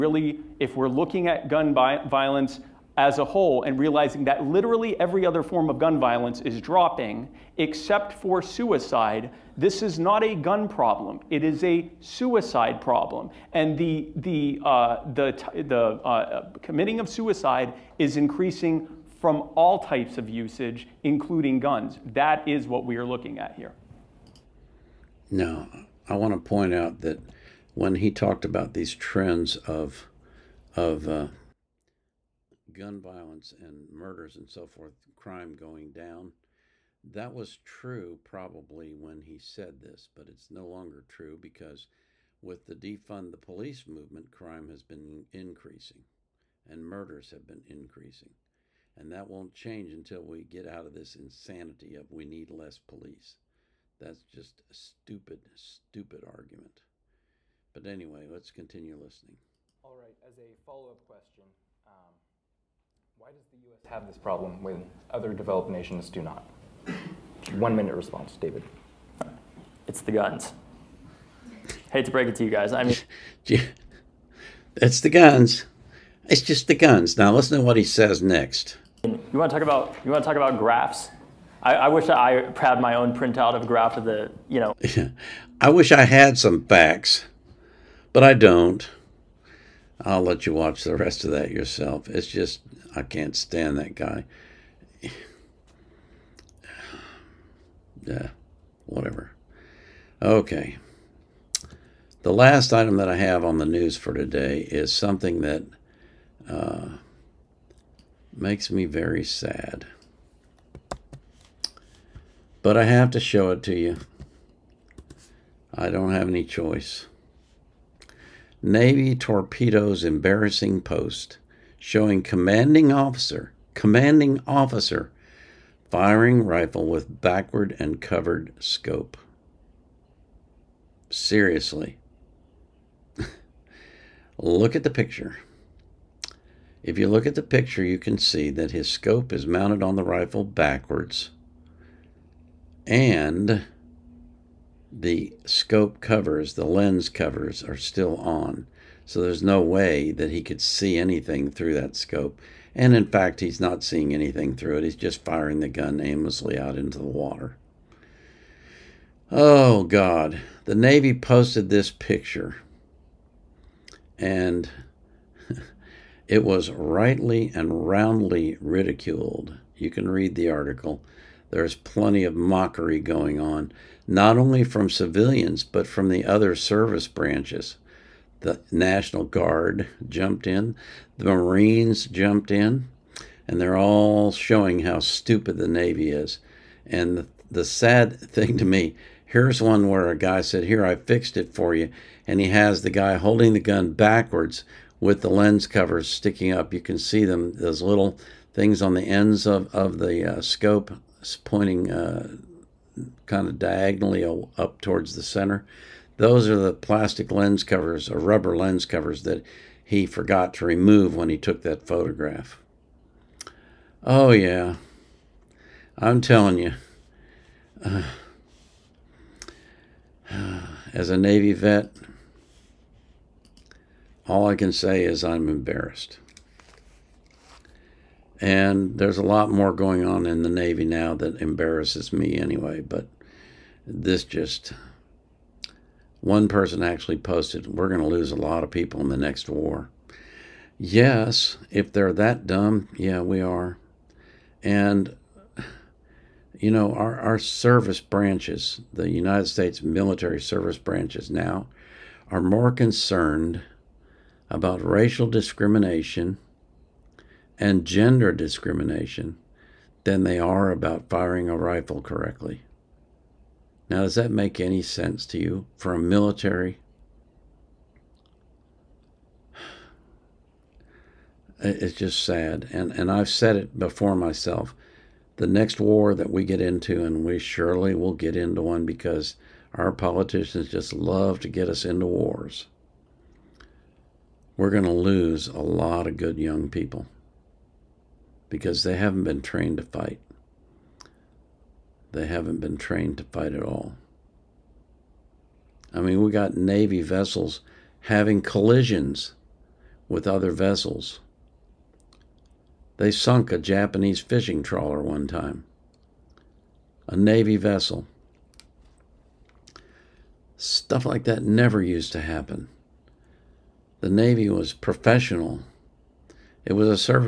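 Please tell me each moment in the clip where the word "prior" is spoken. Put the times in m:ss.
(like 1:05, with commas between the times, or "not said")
not said.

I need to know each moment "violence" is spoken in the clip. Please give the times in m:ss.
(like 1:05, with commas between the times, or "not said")
0:01, 0:05, 0:33.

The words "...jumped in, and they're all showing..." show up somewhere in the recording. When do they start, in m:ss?
3:02.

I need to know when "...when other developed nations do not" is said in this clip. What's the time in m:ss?
1:04.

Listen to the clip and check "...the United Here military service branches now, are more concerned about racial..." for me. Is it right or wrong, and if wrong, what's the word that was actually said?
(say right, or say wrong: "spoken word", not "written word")
wrong: "States", not "Here".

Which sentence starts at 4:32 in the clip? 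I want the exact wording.
And, and I've said it before myself.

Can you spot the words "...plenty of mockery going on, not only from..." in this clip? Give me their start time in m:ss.
2:51.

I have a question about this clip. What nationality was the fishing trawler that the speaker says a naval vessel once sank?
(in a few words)
Japanese.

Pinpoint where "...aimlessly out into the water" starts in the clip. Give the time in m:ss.
2:35.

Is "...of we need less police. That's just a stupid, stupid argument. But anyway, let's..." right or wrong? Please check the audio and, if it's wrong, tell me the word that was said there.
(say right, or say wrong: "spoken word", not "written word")
right.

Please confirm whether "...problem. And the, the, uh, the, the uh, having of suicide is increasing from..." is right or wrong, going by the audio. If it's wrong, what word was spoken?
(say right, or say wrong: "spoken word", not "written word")
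wrong: "committing", not "having".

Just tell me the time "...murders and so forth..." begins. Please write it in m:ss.
0:33.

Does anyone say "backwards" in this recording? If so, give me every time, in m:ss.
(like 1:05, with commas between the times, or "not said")
2:07, 2:20, 3:13.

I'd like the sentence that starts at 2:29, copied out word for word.
So there's no way that he could see anything through that scope.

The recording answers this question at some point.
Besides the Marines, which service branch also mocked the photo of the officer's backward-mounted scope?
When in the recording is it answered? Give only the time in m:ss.
2:58.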